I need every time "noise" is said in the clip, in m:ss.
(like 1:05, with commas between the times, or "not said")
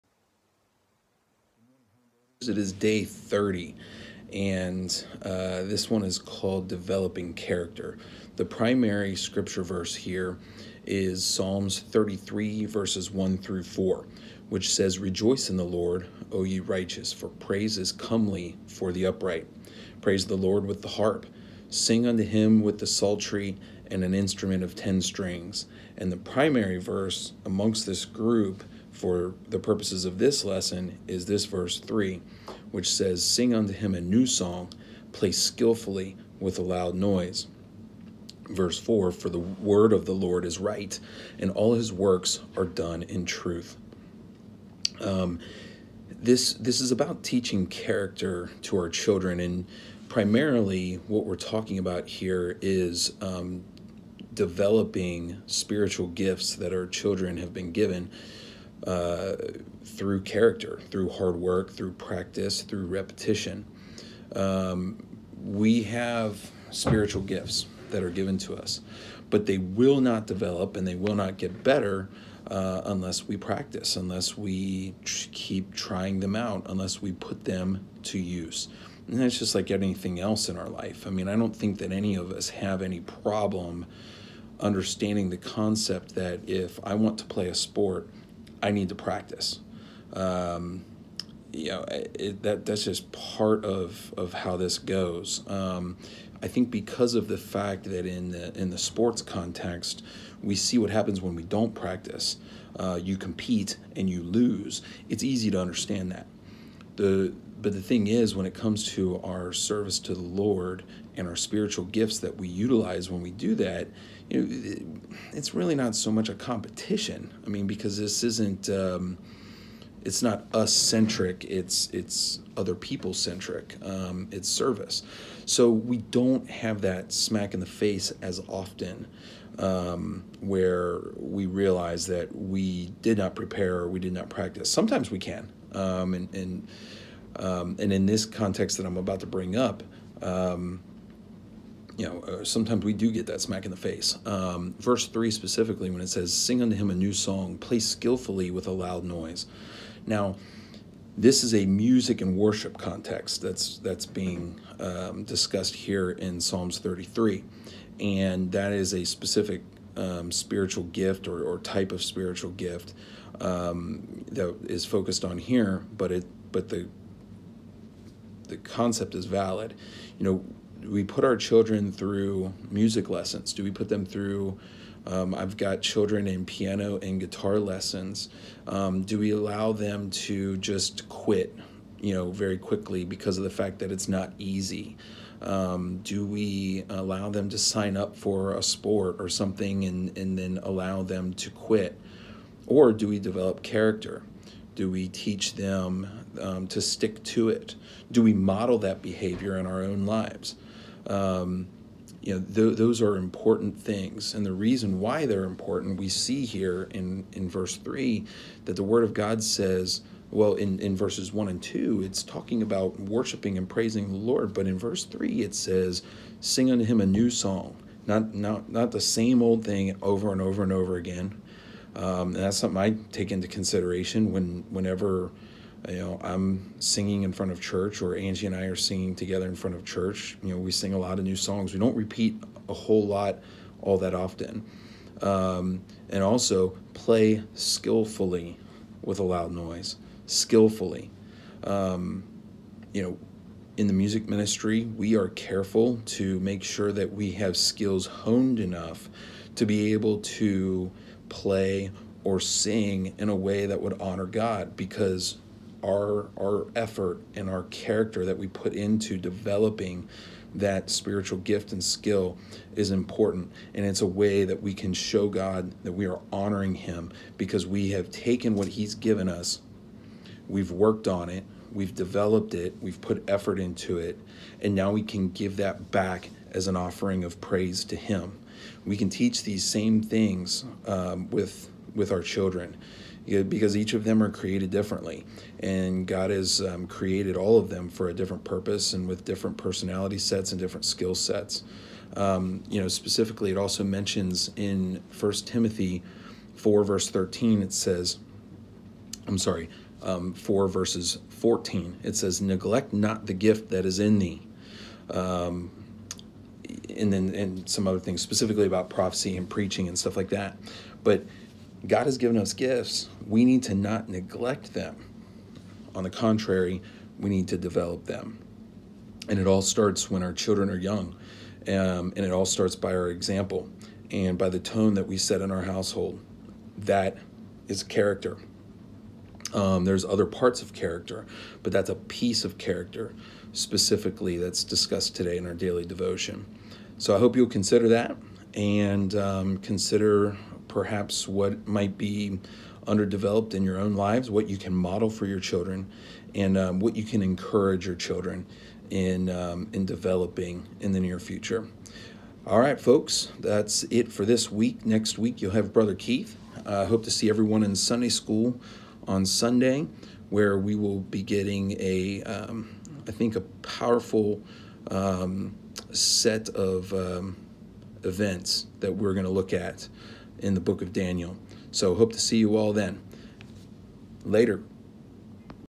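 0:36, 2:29, 3:59.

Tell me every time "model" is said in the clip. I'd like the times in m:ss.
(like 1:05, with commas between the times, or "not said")
3:18, 5:44.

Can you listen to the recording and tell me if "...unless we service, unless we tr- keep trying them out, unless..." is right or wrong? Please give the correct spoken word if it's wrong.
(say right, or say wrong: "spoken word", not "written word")
wrong: "practice", not "service".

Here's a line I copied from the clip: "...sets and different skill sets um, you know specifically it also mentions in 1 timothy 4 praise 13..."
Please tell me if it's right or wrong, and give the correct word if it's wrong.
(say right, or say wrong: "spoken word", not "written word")
wrong: "verse", not "praise".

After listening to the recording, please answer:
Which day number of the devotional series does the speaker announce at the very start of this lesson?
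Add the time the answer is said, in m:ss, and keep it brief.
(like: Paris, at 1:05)
30, at 0:02.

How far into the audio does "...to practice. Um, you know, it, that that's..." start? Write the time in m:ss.
1:28.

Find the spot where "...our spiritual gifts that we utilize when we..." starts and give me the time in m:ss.
1:51.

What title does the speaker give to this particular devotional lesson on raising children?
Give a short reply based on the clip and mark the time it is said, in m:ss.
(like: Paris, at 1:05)
Developing Character, at 0:06.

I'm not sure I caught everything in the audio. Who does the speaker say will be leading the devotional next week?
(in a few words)
Brother Keith.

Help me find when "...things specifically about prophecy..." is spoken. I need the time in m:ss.
5:07.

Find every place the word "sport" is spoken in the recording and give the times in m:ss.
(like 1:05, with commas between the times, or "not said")
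1:27, 1:38, 3:08.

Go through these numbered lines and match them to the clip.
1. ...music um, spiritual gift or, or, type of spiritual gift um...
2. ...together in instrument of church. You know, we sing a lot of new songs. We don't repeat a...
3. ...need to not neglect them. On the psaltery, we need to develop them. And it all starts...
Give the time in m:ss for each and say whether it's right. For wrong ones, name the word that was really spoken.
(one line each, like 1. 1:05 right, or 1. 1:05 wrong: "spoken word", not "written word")
1. 2:39 wrong: "specific", not "music"
2. 3:49 wrong: "front", not "instrument"
3. 5:13 wrong: "contrary", not "psaltery".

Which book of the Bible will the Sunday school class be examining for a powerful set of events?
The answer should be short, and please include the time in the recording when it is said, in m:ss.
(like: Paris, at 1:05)
Daniel, at 6:10.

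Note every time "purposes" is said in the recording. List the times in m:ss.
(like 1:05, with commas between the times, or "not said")
0:29, 4:48.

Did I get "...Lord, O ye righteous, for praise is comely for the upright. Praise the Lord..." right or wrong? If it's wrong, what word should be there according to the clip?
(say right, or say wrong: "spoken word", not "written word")
right.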